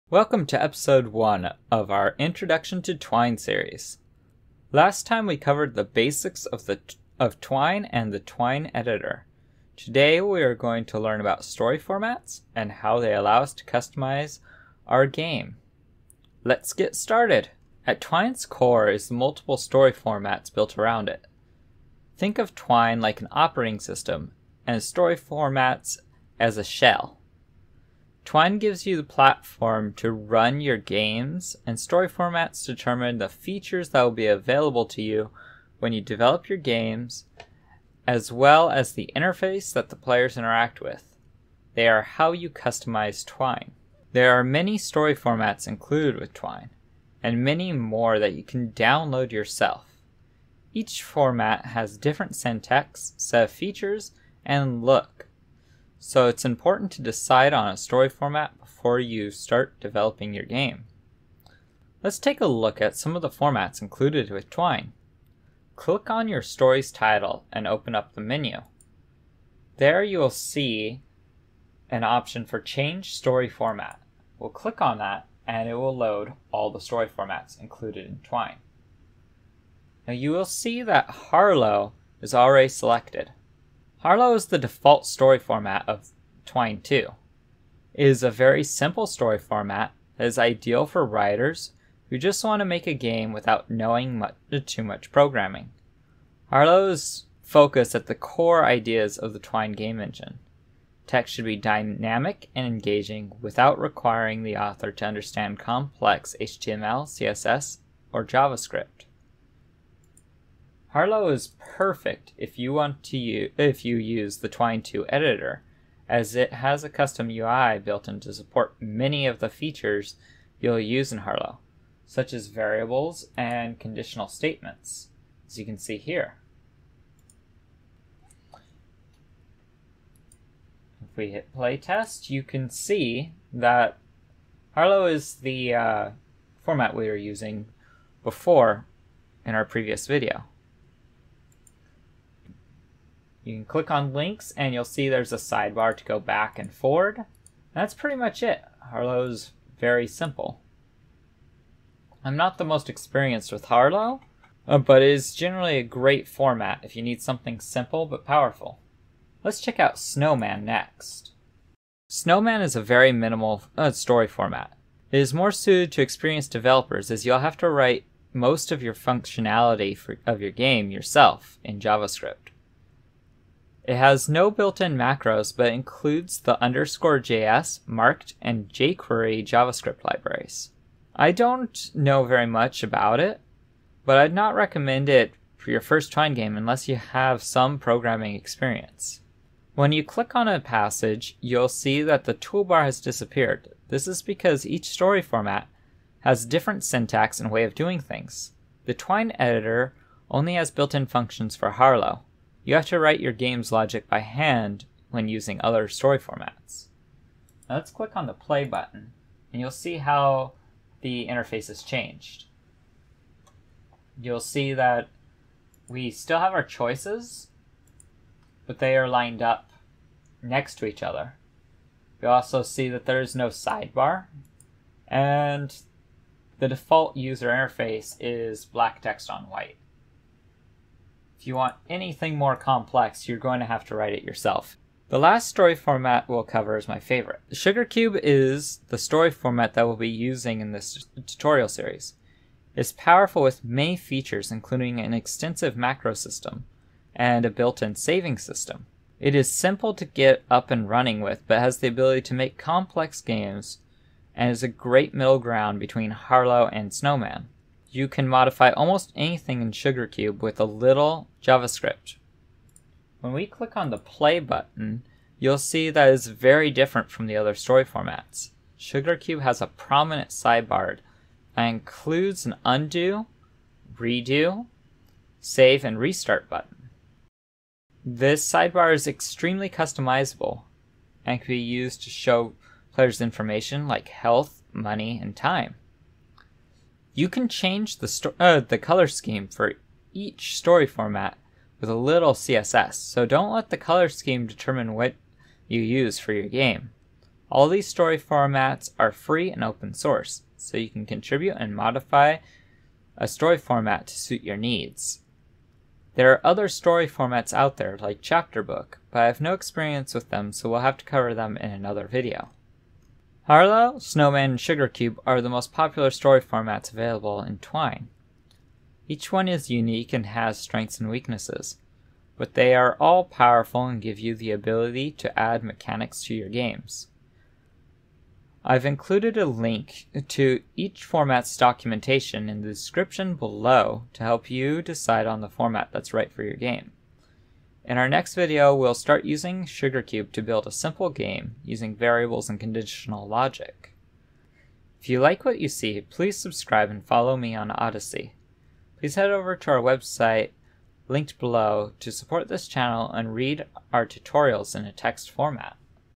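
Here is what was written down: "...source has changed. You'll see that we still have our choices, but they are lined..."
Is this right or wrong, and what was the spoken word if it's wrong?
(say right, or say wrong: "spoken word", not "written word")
wrong: "interface", not "source".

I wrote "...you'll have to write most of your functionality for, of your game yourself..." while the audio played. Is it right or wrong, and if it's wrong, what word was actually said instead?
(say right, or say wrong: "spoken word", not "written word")
right.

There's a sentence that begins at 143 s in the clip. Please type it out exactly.
You can click on links and you'll see there's a sidebar to go back and forward.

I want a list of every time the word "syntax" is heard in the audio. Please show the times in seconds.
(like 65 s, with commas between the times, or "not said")
52 s, 196 s.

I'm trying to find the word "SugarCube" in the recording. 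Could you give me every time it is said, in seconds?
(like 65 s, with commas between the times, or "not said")
237 s, 259 s, 268 s, 314 s, 339 s.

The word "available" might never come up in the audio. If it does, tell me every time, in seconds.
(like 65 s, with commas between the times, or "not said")
34 s, 316 s.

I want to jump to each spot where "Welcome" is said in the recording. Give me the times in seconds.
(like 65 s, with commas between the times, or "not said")
0 s.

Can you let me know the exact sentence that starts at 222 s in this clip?
You also see that there is no sidebar, and the default user interface is black text on white.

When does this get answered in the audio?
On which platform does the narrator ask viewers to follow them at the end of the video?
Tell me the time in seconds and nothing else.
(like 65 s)
347 s.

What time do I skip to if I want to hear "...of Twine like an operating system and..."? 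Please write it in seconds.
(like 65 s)
22 s.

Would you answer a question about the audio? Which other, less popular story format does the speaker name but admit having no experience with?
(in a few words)
Chapter book.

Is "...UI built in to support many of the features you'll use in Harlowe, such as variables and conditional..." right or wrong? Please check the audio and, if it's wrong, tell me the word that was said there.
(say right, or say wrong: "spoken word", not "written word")
right.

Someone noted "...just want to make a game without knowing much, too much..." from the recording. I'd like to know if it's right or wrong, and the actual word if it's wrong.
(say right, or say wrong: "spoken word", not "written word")
right.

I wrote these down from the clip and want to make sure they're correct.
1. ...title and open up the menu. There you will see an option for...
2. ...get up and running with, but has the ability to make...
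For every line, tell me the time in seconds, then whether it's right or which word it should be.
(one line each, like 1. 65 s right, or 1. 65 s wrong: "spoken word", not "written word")
1. 66 s right
2. 250 s right.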